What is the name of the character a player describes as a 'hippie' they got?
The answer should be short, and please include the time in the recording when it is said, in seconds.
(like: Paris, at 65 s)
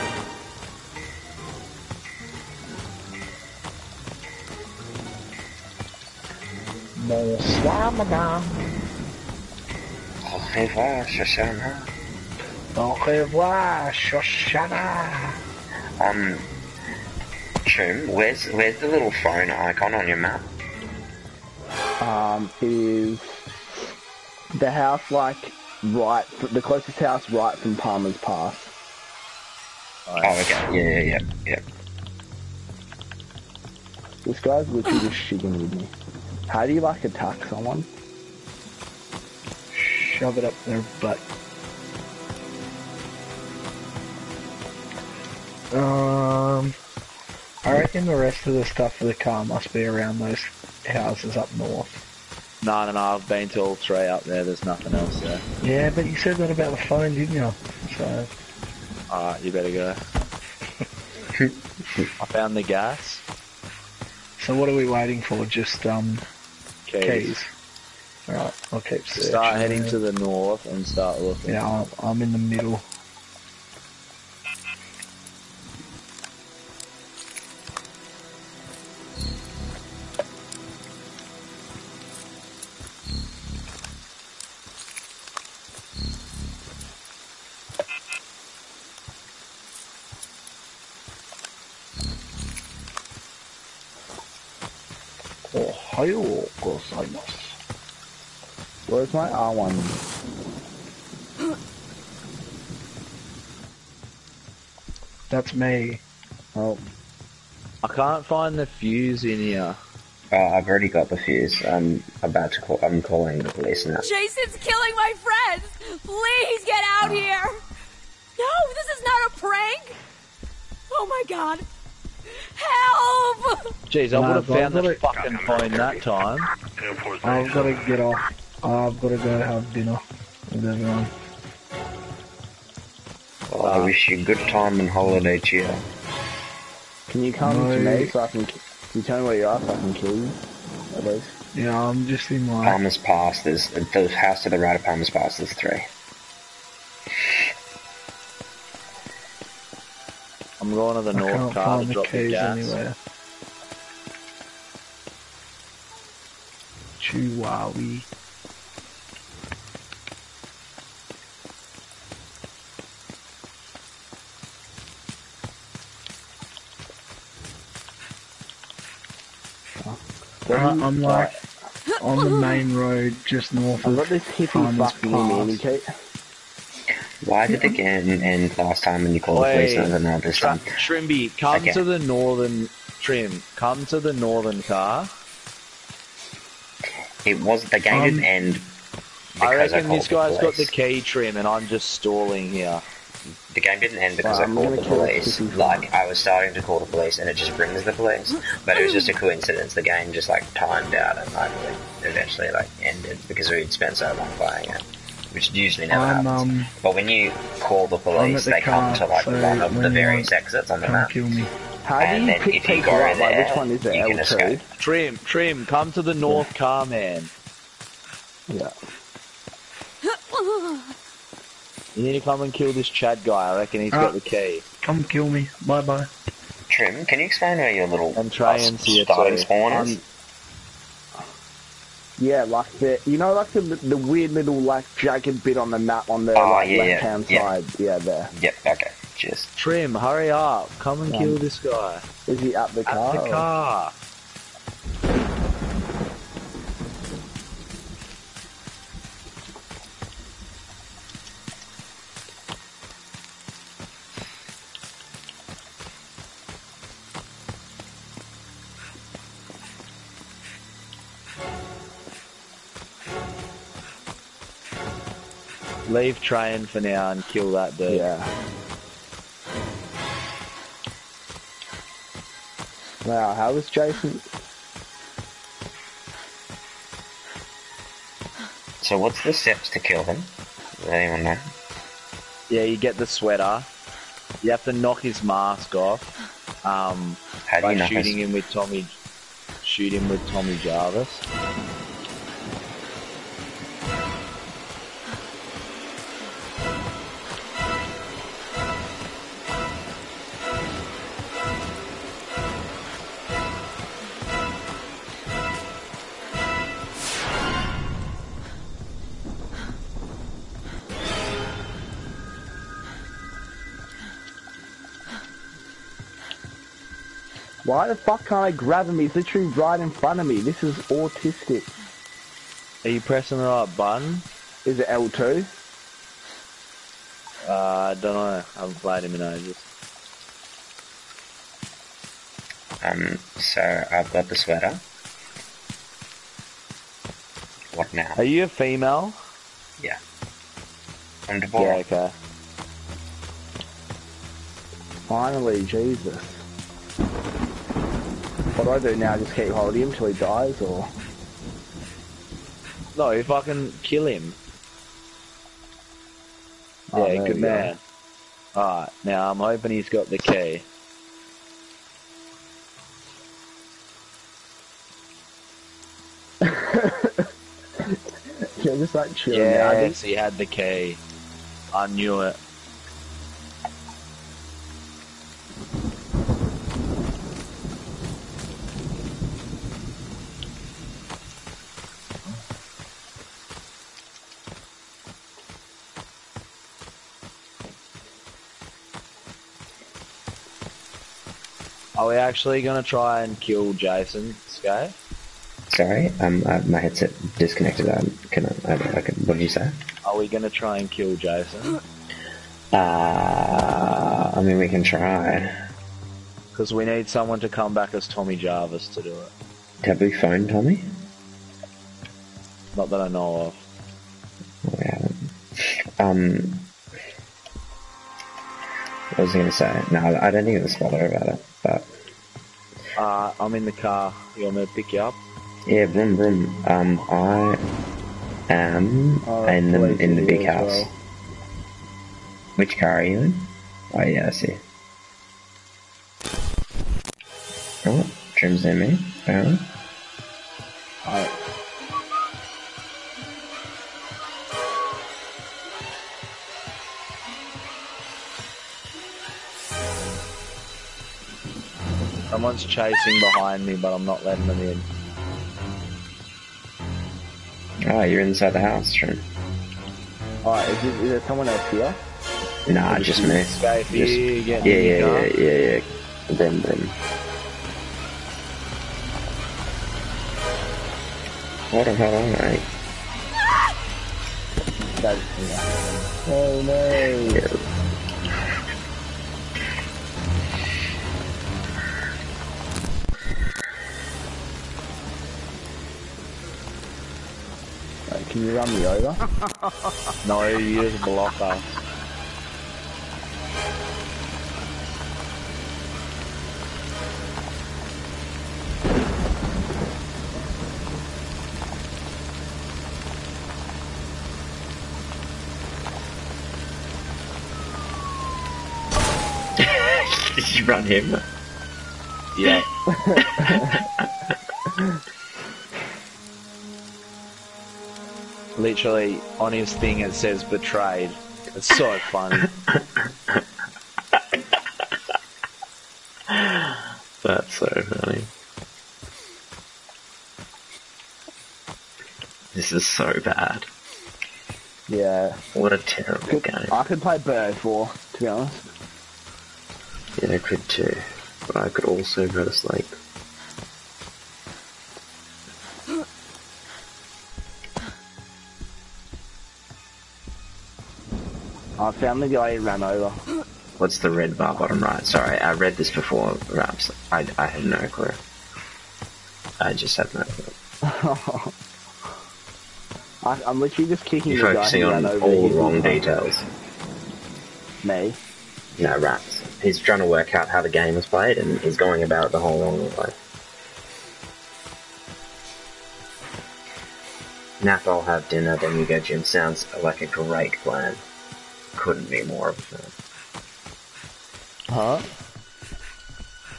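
Kate, at 175 s.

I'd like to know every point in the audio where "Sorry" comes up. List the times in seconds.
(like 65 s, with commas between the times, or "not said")
395 s, 555 s.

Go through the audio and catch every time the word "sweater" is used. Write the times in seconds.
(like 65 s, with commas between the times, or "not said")
283 s, 334 s.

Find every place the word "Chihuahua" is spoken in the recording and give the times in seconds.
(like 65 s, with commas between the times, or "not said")
157 s.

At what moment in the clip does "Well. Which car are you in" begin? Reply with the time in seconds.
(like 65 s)
430 s.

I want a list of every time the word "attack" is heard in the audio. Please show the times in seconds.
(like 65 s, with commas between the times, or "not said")
37 s.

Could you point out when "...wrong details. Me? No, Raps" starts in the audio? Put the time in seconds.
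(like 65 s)
565 s.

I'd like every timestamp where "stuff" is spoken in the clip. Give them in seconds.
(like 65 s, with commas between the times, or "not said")
48 s.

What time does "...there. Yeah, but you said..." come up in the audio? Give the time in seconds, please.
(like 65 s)
55 s.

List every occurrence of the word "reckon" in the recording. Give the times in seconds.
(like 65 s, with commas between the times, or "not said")
47 s, 189 s, 223 s.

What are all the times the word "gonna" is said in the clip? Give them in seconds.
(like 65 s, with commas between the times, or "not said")
392 s, 400 s.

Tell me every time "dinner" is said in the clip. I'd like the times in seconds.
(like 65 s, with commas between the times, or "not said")
129 s, 578 s.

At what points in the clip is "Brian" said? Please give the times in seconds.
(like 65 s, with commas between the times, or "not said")
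not said.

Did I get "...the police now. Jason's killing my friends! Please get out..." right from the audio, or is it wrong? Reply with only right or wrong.
right.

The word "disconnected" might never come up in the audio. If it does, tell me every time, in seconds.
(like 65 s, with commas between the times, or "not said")
397 s.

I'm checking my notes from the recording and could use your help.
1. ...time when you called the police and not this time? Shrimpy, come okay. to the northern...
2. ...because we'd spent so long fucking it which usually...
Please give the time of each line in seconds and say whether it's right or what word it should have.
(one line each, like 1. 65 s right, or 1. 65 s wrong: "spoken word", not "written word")
1. 178 s right
2. 203 s wrong: "playing", not "fucking".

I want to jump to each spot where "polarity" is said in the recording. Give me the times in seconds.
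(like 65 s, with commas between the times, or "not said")
not said.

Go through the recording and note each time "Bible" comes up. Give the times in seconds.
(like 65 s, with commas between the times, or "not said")
not said.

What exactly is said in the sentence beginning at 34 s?
This guy's literally just shitting with me.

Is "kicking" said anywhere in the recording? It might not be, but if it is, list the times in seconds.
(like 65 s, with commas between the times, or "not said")
564 s.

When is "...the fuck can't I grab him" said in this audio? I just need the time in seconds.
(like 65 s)
317 s.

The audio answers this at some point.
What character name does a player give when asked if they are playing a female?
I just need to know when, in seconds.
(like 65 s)
341 s.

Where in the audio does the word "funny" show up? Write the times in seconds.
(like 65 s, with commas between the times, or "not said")
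522 s, 527 s.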